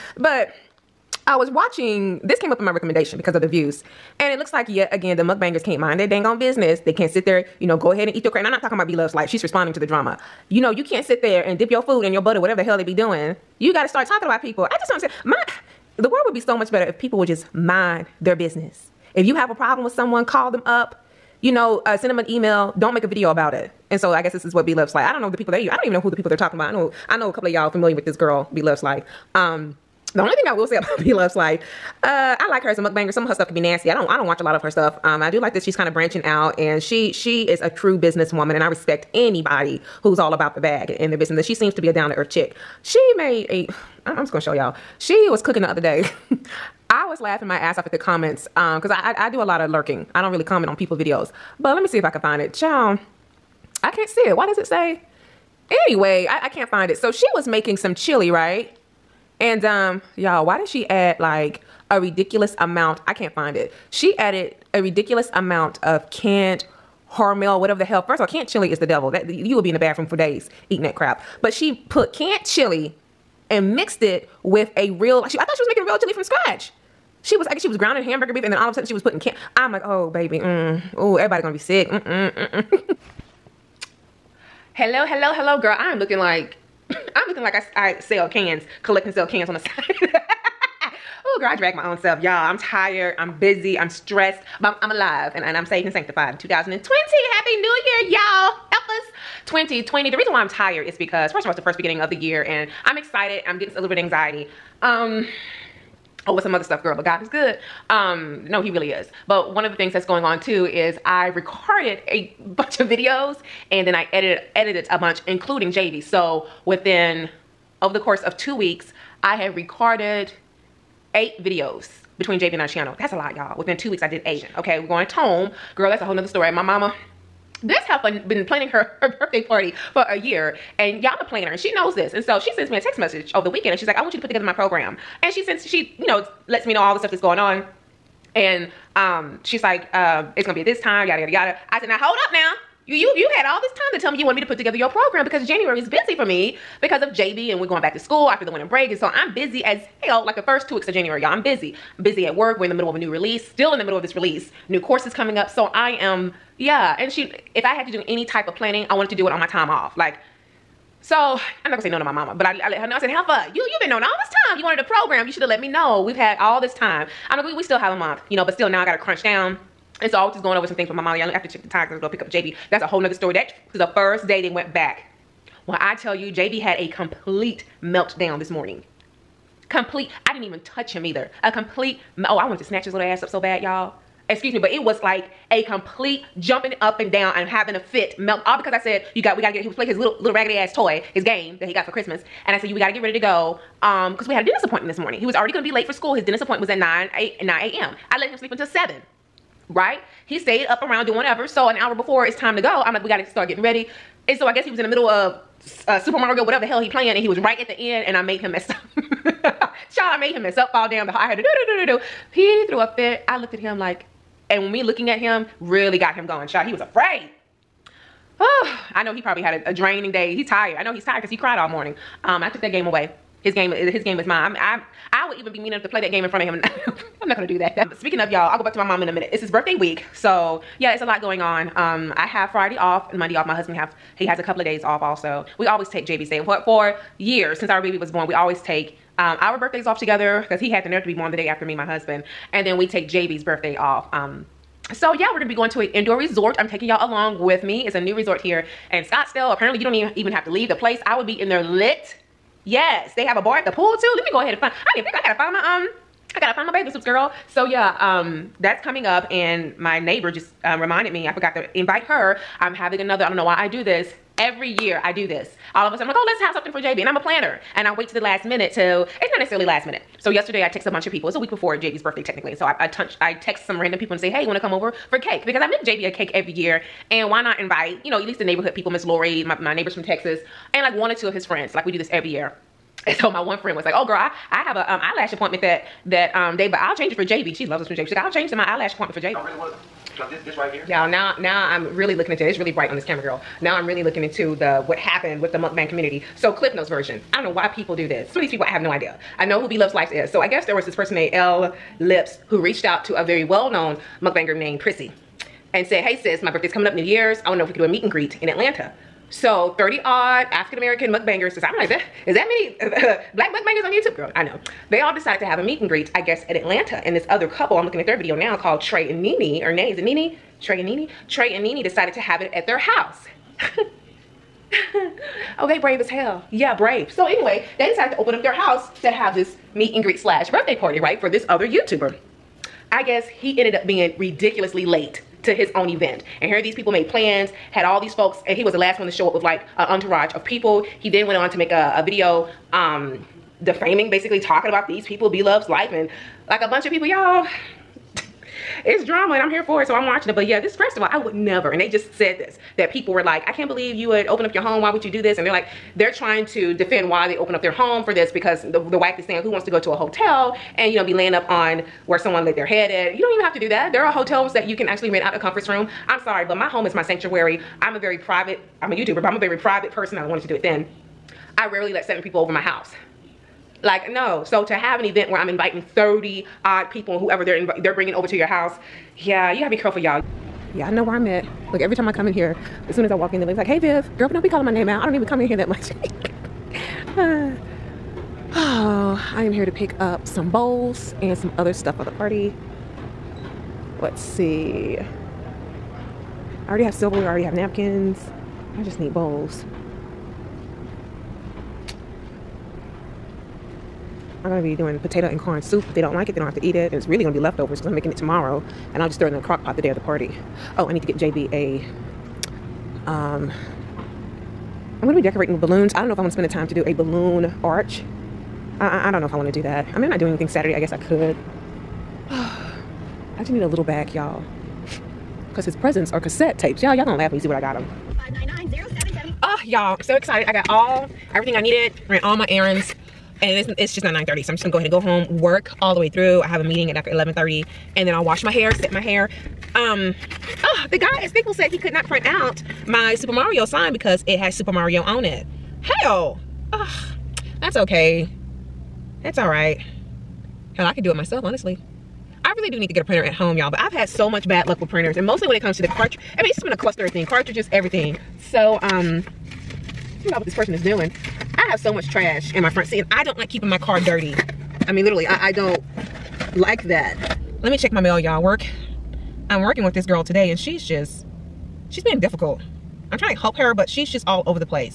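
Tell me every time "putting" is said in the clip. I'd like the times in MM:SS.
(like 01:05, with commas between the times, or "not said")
01:19.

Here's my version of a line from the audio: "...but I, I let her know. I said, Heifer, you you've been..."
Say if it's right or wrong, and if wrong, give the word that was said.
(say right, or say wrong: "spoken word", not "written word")
right.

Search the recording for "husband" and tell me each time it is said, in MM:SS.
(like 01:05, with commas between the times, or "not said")
03:53, 04:01.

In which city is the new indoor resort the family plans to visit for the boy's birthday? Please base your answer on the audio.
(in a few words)
Scottsdale.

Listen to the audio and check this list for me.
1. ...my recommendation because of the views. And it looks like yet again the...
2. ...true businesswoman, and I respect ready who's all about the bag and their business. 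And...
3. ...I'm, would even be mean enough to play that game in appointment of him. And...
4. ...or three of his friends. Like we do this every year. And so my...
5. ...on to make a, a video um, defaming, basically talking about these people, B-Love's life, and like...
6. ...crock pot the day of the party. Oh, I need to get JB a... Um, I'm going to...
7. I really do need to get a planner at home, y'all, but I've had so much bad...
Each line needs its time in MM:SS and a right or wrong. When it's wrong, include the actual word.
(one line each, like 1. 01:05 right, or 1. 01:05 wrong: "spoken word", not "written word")
1. 00:02 right
2. 00:37 wrong: "anybody", not "ready"
3. 03:44 wrong: "front", not "appointment"
4. 04:41 wrong: "two", not "three"
5. 05:41 right
6. 06:49 right
7. 07:32 wrong: "printer", not "planner".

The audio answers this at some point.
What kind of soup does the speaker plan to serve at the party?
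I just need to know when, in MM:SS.
06:44.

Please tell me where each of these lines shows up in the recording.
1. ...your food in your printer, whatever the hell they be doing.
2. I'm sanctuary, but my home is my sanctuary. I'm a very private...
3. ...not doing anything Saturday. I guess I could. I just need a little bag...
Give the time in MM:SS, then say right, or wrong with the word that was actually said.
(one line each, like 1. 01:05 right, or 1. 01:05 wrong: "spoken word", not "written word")
1. 00:11 wrong: "butter", not "printer"
2. 06:06 wrong: "sorry", not "sanctuary"
3. 07:00 right.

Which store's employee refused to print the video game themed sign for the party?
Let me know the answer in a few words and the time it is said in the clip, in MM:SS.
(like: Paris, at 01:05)
Staples, at 07:21.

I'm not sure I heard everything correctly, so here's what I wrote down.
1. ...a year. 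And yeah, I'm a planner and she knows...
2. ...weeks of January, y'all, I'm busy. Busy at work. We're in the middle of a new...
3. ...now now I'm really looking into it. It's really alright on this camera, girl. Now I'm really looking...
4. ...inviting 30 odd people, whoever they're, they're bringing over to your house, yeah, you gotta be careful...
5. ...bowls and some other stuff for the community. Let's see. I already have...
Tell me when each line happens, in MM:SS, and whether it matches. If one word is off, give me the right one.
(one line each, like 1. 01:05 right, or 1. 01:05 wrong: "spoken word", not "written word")
1. 02:10 right
2. 02:30 right
3. 04:51 wrong: "bright", not "alright"
4. 06:15 right
5. 06:30 wrong: "party", not "community".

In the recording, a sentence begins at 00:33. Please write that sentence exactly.
Some of her stuff could be nasty.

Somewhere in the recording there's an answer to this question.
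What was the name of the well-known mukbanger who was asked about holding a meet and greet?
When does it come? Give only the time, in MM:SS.
05:04.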